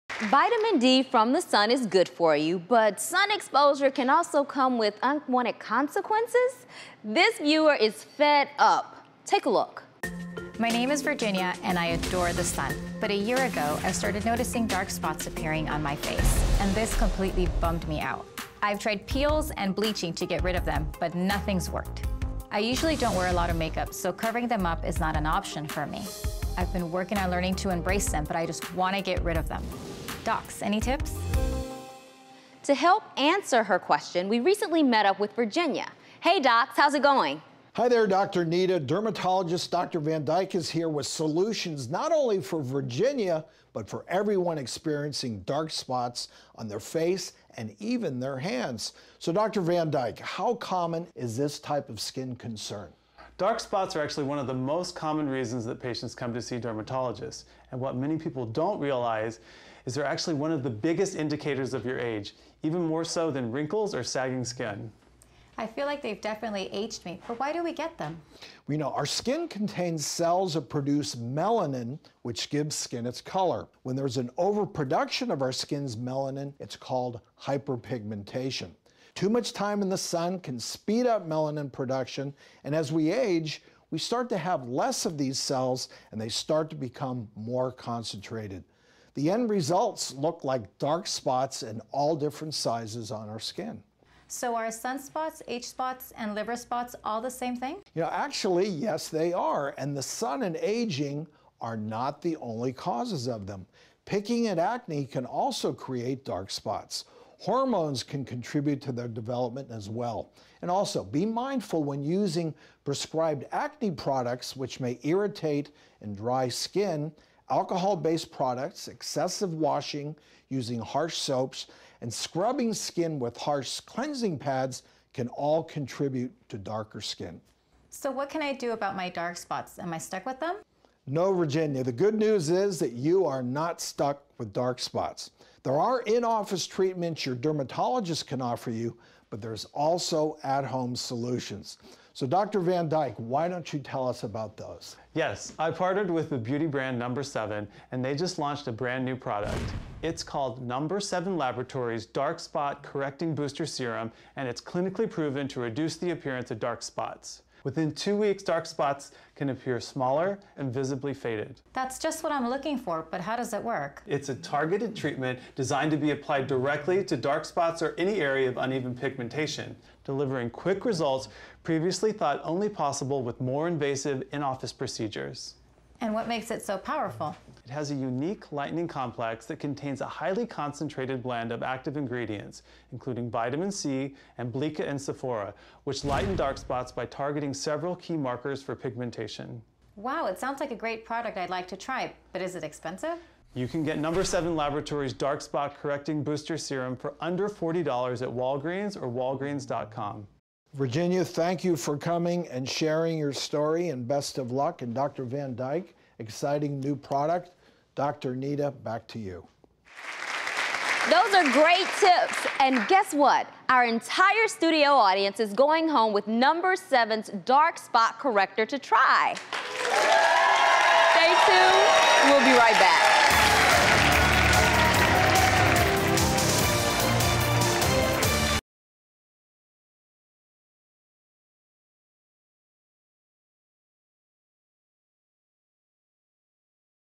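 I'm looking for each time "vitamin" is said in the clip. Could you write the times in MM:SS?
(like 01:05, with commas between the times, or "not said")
00:00, 03:03.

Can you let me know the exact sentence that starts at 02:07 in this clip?
So, what can I do about my dark spots?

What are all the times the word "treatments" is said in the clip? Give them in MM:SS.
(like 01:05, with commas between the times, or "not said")
02:16, 02:44.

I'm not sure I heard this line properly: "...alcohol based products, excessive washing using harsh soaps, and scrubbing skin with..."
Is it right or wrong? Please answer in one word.
right.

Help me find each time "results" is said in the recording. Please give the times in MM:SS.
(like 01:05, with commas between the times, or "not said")
01:29, 02:50.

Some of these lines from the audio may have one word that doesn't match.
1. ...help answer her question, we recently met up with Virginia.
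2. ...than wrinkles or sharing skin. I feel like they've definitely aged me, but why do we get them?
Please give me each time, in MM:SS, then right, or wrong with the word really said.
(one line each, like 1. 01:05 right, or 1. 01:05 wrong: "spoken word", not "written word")
1. 00:32 right
2. 01:03 wrong: "sagging", not "sharing".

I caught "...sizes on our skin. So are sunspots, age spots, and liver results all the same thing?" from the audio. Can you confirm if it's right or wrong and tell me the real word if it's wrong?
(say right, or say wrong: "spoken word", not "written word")
wrong: "spots", not "results".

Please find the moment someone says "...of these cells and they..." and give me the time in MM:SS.
01:25.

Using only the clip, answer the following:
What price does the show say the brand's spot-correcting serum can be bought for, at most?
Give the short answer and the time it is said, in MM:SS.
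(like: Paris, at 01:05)
under $40, at 03:17.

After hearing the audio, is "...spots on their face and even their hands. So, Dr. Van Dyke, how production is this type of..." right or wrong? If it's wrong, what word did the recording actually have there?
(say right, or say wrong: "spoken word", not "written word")
wrong: "common", not "production".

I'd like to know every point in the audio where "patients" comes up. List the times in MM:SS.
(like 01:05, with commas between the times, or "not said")
00:55.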